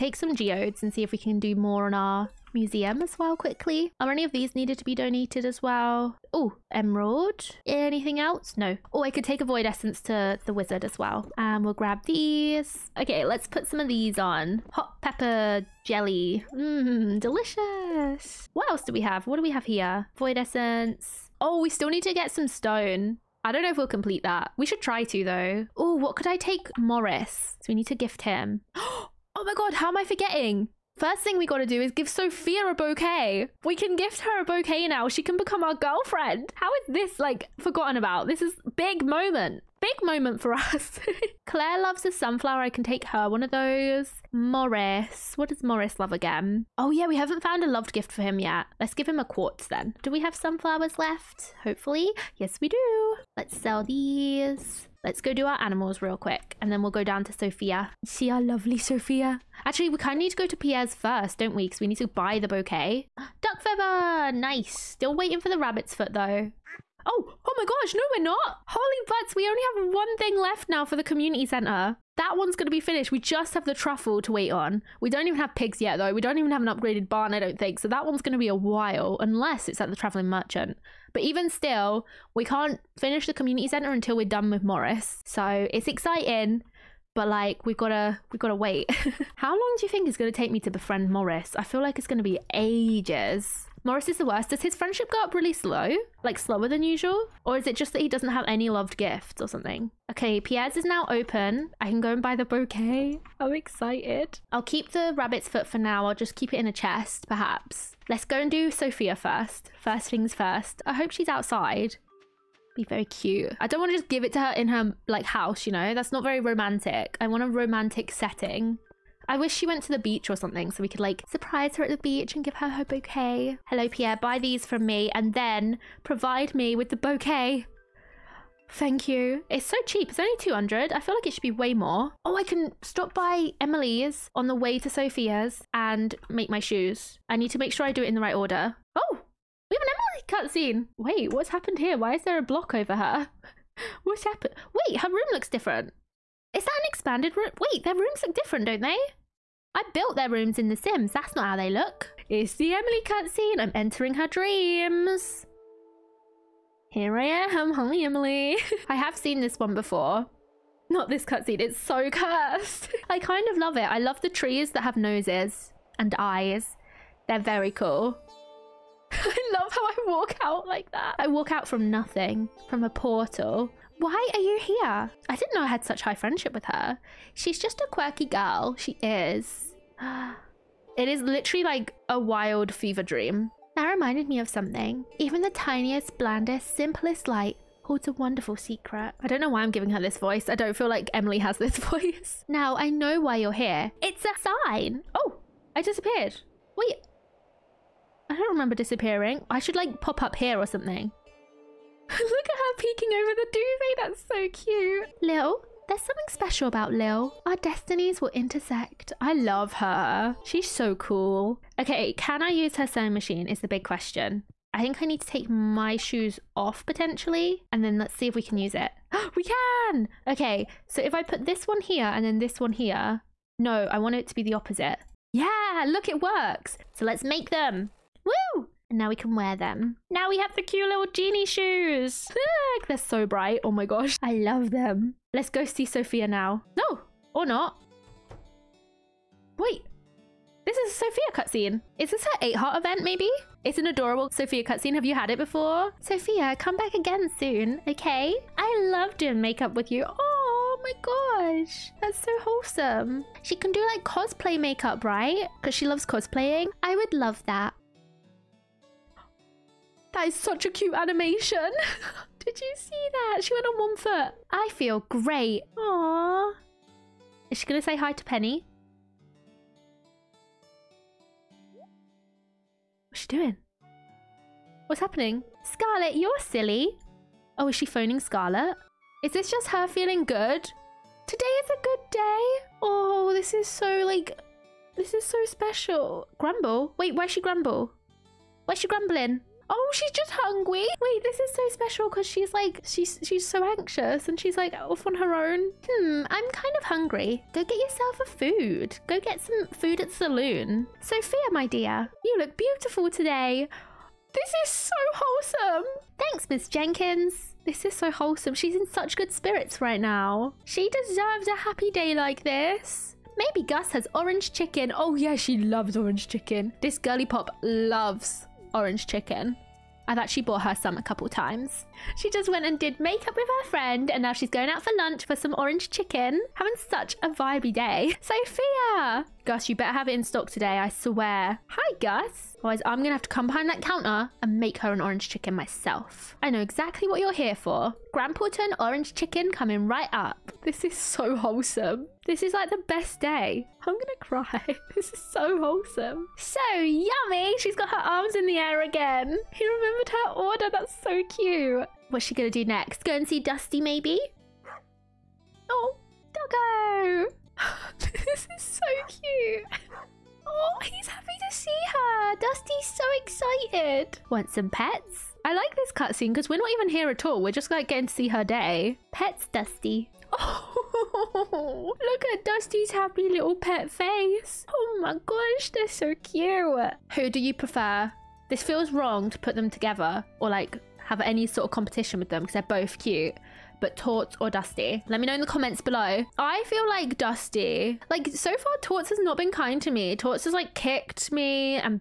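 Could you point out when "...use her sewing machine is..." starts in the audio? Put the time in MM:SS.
03:32.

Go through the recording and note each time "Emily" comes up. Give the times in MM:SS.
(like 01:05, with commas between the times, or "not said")
02:13, 02:20, 02:32, 02:37, 03:11.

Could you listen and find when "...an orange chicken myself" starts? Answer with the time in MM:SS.
05:34.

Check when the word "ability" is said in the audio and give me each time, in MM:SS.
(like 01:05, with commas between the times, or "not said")
not said.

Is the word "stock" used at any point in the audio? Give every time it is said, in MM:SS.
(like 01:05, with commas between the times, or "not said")
05:30.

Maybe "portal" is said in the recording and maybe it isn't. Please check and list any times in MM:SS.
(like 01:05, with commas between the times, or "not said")
02:52.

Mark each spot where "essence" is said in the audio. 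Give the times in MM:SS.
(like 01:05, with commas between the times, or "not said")
00:09, 00:20.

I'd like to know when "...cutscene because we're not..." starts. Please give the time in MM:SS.
06:05.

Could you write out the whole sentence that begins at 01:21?
But even still, we can't finish the community center until we're done with Morris.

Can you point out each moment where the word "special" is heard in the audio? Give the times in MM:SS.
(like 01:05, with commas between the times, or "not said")
03:26, 04:45, 04:51.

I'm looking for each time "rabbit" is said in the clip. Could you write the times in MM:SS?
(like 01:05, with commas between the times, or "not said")
01:05, 01:45.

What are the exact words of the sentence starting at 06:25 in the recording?
Let me know in the comments below.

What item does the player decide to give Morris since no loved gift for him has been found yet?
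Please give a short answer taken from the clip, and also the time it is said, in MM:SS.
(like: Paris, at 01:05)
Quartz, at 00:49.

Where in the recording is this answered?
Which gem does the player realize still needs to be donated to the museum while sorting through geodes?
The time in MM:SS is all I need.
00:06.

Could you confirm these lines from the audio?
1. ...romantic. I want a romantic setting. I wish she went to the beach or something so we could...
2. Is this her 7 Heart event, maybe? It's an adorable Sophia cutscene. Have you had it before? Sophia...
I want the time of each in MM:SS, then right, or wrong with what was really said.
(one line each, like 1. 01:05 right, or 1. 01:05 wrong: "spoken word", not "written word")
1. 01:56 right
2. 04:01 wrong: "8", not "7".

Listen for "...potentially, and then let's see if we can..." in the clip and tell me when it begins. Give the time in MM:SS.
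03:36.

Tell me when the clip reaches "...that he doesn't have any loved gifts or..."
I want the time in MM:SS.
01:37.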